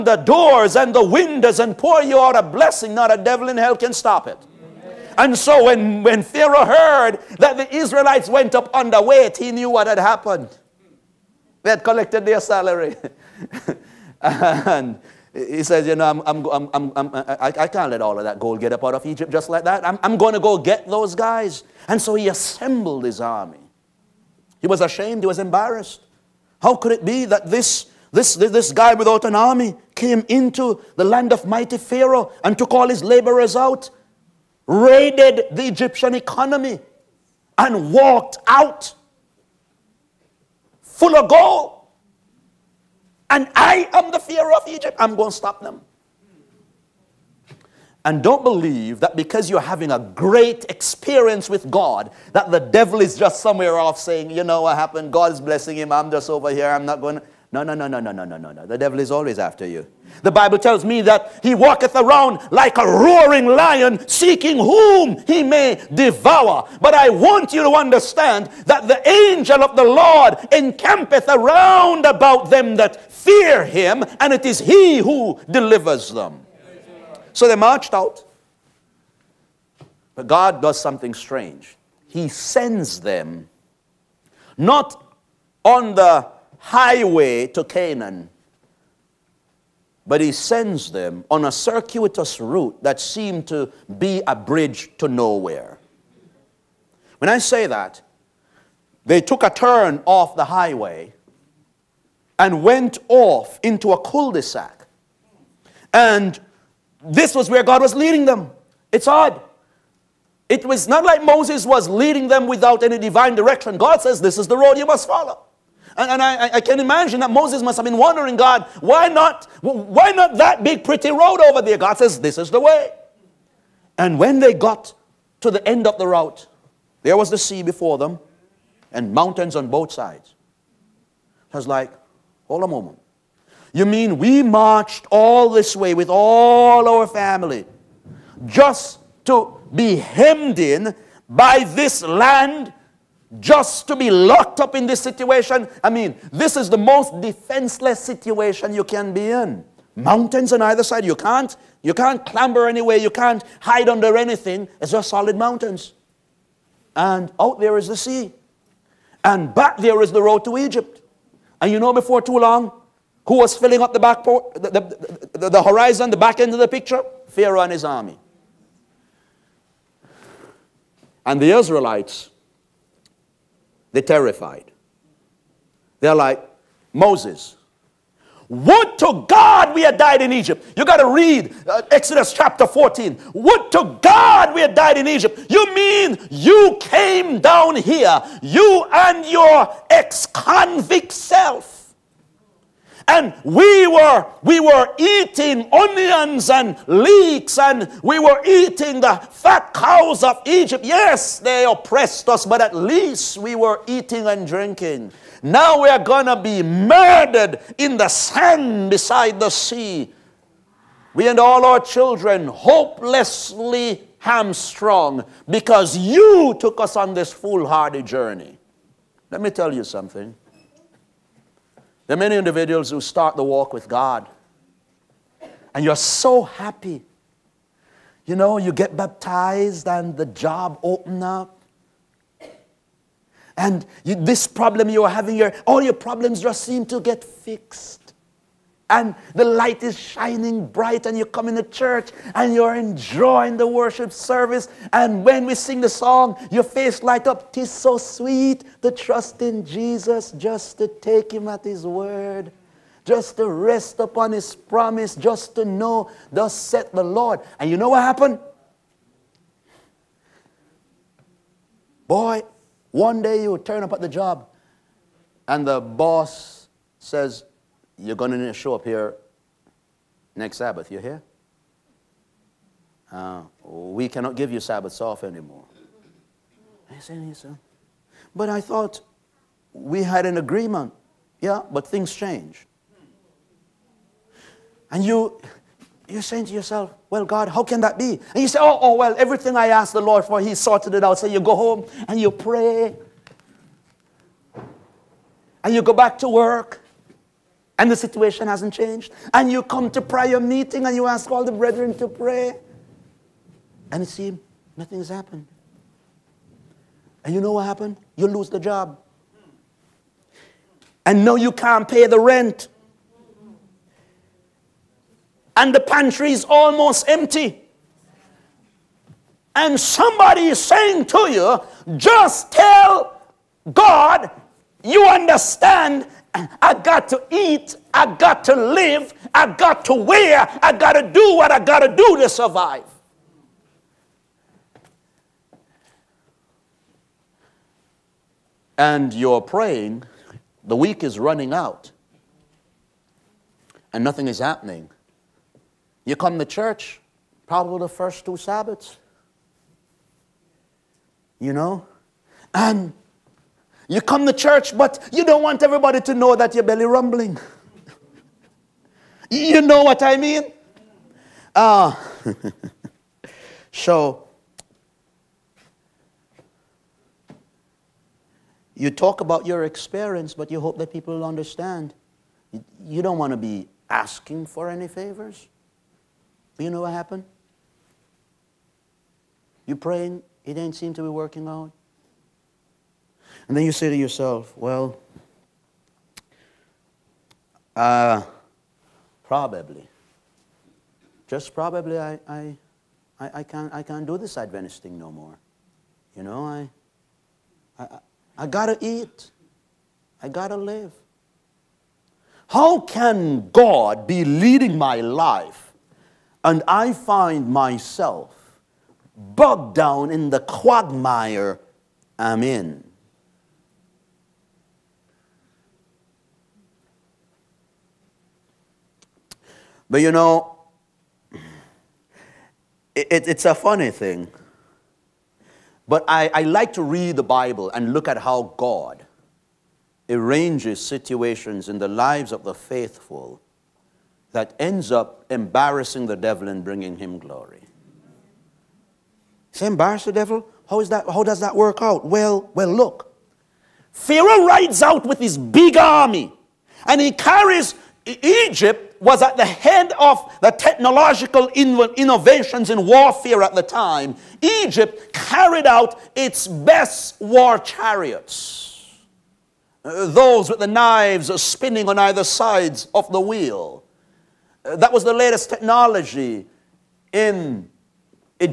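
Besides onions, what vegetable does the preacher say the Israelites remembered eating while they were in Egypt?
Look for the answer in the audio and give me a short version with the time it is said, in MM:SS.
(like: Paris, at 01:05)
Leeks, at 03:16.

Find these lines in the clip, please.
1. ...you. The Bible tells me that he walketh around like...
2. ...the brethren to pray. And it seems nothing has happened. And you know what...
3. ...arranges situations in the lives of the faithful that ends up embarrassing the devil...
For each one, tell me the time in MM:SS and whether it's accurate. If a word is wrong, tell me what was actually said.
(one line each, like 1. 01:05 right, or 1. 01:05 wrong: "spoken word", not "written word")
1. 00:59 right
2. 05:01 right
3. 07:10 right.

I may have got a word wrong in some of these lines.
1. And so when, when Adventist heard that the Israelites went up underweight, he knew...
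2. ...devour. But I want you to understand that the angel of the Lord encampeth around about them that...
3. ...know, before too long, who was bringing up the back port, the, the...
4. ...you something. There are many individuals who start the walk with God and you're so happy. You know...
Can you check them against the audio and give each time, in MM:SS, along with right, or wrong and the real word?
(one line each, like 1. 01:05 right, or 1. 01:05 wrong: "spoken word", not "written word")
1. 00:05 wrong: "Pharaoh", not "Adventist"
2. 01:05 right
3. 02:41 wrong: "filling", not "bringing"
4. 03:39 right.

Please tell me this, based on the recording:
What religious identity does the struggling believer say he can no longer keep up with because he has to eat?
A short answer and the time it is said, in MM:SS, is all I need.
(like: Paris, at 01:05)
Adventist, at 06:34.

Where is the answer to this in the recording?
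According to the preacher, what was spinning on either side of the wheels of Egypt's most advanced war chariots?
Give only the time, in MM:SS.
07:40.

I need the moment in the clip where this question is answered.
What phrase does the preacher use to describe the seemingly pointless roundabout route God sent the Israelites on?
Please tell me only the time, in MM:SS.
01:34.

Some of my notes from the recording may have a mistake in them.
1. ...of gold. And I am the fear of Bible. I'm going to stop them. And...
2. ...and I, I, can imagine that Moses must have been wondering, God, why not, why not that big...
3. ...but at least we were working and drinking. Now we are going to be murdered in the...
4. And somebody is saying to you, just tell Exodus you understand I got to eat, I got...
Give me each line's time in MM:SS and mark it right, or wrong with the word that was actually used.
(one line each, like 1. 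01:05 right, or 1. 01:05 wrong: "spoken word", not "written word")
1. 00:41 wrong: "Egypt", not "Bible"
2. 01:56 right
3. 03:22 wrong: "eating", not "working"
4. 05:19 wrong: "God", not "Exodus".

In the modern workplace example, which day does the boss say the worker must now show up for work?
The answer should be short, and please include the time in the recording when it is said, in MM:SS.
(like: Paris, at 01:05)
Next Sabbath, at 04:30.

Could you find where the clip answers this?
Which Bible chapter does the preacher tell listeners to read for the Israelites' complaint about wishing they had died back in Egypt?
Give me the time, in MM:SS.
03:01.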